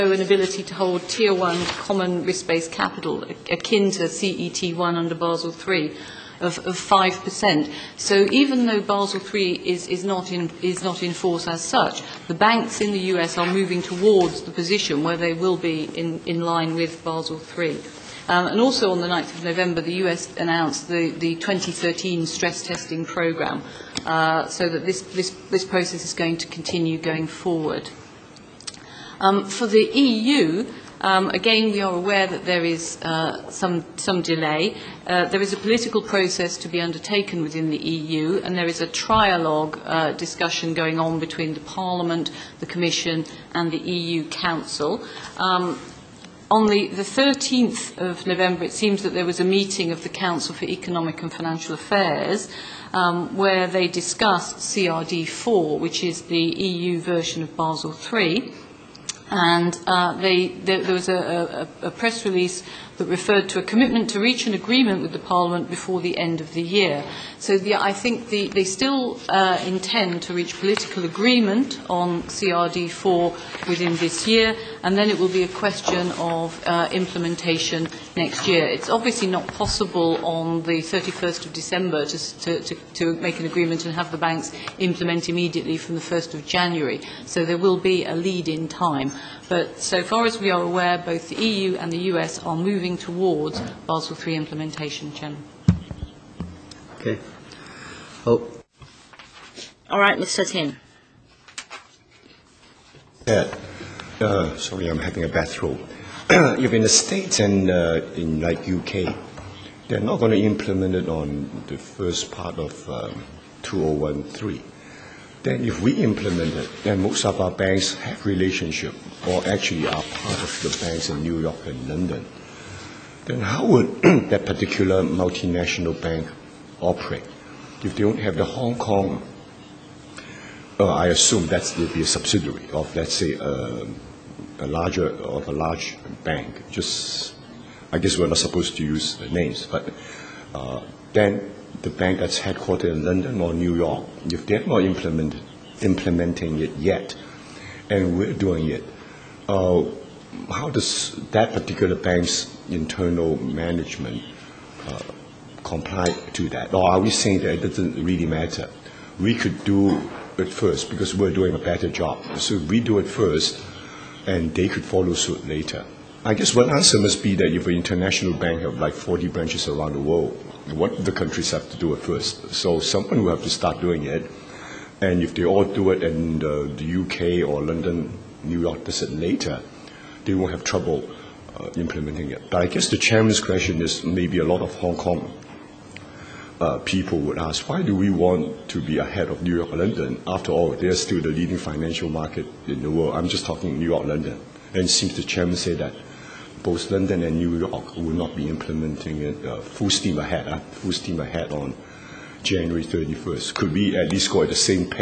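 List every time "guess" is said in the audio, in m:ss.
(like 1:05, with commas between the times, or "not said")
2:17, 2:46, 3:02.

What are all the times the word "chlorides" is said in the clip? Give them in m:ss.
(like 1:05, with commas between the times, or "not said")
not said.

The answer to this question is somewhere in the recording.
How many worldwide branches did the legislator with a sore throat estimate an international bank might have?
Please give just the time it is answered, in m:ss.
2:48.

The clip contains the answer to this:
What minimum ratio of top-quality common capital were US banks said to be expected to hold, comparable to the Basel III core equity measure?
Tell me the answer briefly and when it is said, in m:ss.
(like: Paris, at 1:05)
5%, at 0:06.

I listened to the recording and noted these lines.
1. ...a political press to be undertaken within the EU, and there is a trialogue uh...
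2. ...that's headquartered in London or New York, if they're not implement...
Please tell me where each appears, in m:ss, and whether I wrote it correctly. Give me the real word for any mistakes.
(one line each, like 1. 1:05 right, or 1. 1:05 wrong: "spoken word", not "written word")
1. 0:35 wrong: "process", not "press"
2. 2:22 right.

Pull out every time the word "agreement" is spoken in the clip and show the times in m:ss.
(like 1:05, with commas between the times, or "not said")
1:04, 1:11, 1:23.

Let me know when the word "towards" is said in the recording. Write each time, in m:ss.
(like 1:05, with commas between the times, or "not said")
0:13, 1:32.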